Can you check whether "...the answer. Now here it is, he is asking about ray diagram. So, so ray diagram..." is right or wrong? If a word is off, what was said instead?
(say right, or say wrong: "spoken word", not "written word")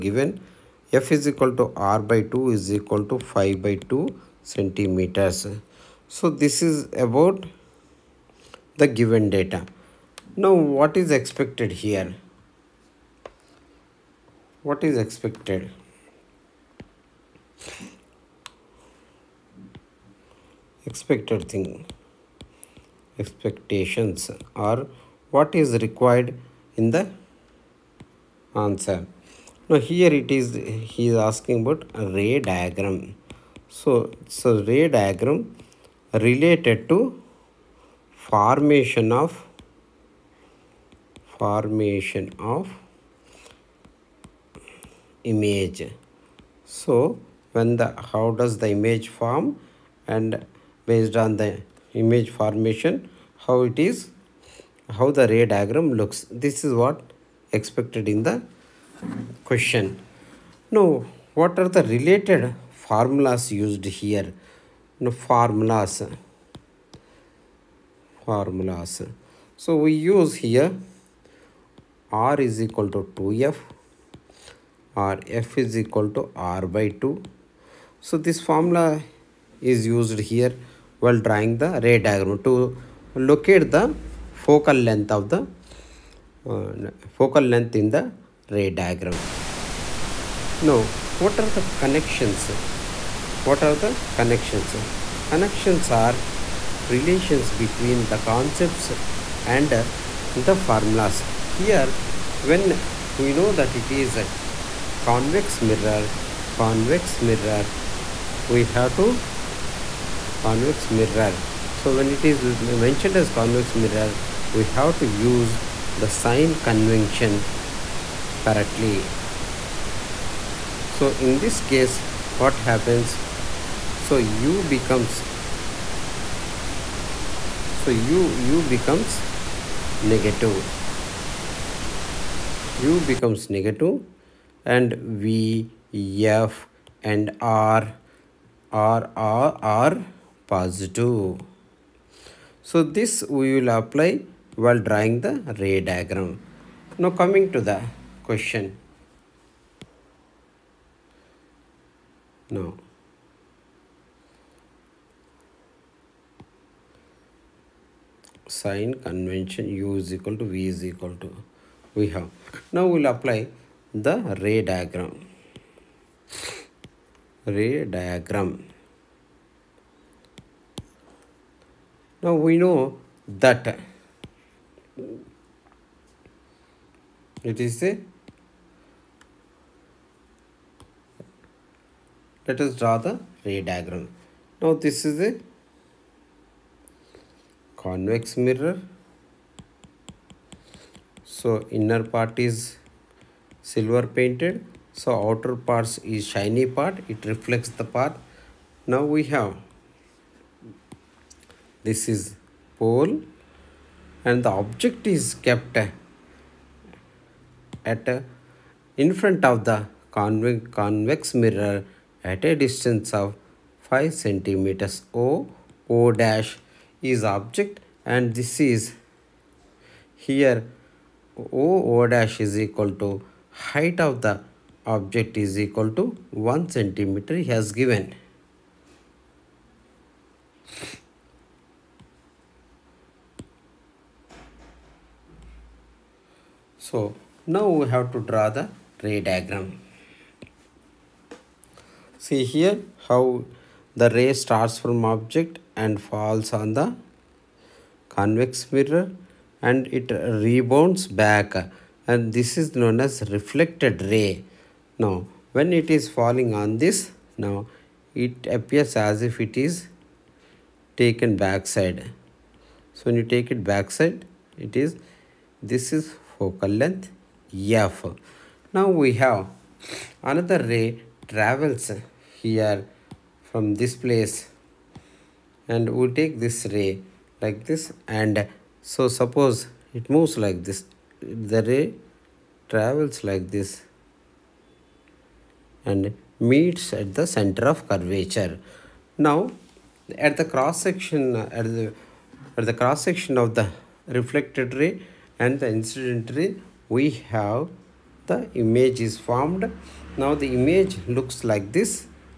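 right.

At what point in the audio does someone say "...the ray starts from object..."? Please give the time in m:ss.
4:03.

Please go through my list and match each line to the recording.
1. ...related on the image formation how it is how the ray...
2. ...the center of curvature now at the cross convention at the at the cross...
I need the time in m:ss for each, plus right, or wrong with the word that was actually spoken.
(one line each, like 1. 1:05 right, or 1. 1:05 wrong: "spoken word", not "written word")
1. 0:50 wrong: "based", not "related"
2. 4:47 wrong: "section", not "convention".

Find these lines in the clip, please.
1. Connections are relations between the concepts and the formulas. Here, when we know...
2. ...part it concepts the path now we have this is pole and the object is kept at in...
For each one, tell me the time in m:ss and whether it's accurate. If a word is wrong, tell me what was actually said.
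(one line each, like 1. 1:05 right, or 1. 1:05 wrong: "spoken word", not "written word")
1. 1:35 right
2. 3:16 wrong: "reflects", not "concepts".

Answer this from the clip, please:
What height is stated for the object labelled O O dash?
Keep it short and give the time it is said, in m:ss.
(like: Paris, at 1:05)
1 cm, at 3:46.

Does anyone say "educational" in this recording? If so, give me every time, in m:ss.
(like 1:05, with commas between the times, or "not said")
not said.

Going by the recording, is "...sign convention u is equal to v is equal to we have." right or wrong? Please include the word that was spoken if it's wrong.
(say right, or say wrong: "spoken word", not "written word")
right.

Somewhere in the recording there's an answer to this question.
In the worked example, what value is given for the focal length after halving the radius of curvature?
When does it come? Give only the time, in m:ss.
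0:03.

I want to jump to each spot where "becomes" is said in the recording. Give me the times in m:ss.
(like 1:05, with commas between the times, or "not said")
2:04, 2:08, 2:12.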